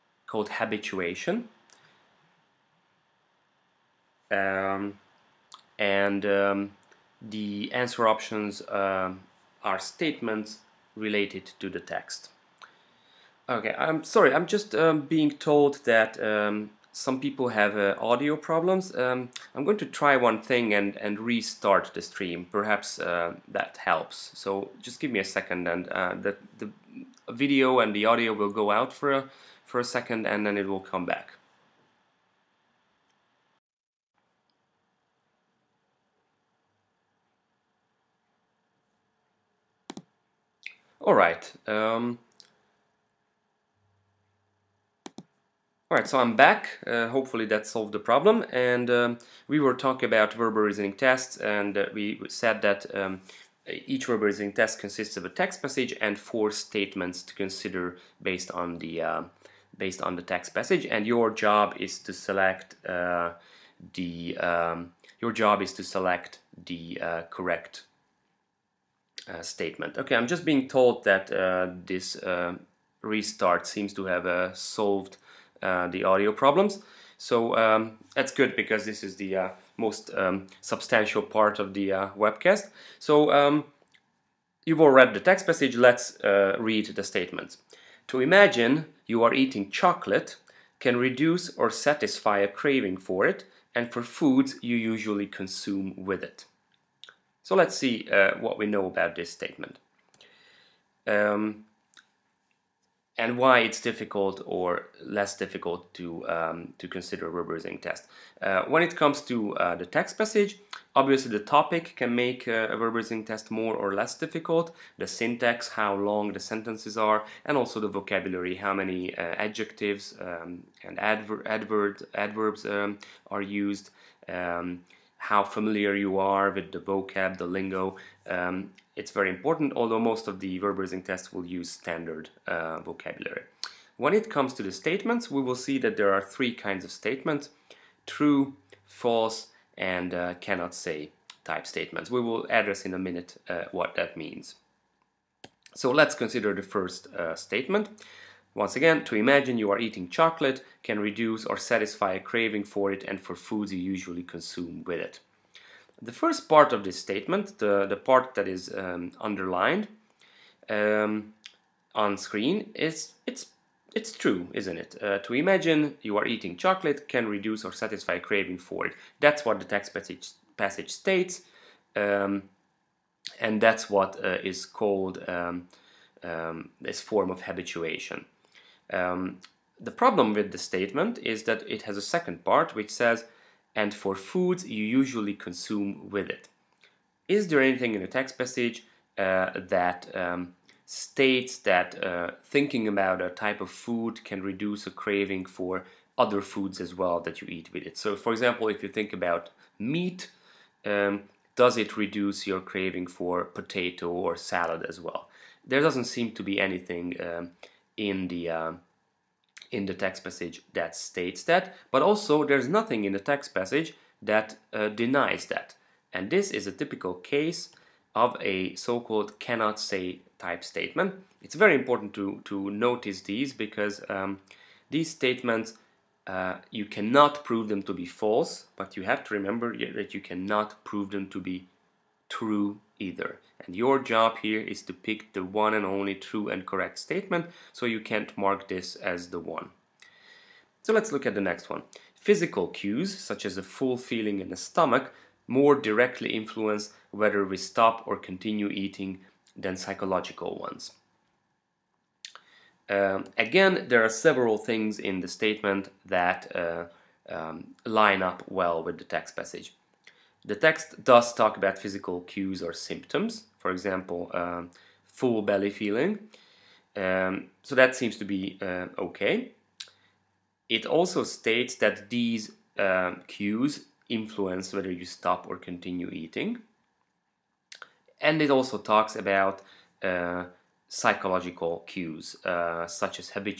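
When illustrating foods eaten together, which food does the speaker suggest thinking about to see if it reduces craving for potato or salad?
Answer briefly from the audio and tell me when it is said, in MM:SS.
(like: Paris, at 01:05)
meat, at 03:19.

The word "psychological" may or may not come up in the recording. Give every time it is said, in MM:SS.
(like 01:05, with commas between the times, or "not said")
04:09, 04:40.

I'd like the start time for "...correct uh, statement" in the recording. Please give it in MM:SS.
01:07.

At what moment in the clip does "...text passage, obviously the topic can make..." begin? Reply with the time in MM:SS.
01:49.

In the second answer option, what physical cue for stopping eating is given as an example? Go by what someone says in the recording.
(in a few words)
a full feeling in the stomach.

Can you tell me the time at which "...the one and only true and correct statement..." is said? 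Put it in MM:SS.
03:55.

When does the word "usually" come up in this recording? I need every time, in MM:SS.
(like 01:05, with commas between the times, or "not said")
01:34, 02:33, 03:04.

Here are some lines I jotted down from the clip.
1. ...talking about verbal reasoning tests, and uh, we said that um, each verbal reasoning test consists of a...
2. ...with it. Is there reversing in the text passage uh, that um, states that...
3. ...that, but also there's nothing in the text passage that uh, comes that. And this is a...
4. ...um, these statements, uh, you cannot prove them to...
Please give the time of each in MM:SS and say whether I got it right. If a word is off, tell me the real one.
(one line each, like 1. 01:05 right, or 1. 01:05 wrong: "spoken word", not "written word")
1. 00:49 right
2. 03:06 wrong: "anything", not "reversing"
3. 03:31 wrong: "denies", not "comes"
4. 03:44 right.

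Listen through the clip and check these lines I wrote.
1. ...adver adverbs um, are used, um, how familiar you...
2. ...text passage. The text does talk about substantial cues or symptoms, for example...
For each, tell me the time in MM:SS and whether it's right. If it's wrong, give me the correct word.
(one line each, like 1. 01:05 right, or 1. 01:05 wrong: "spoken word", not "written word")
1. 02:01 right
2. 04:19 wrong: "physical", not "substantial".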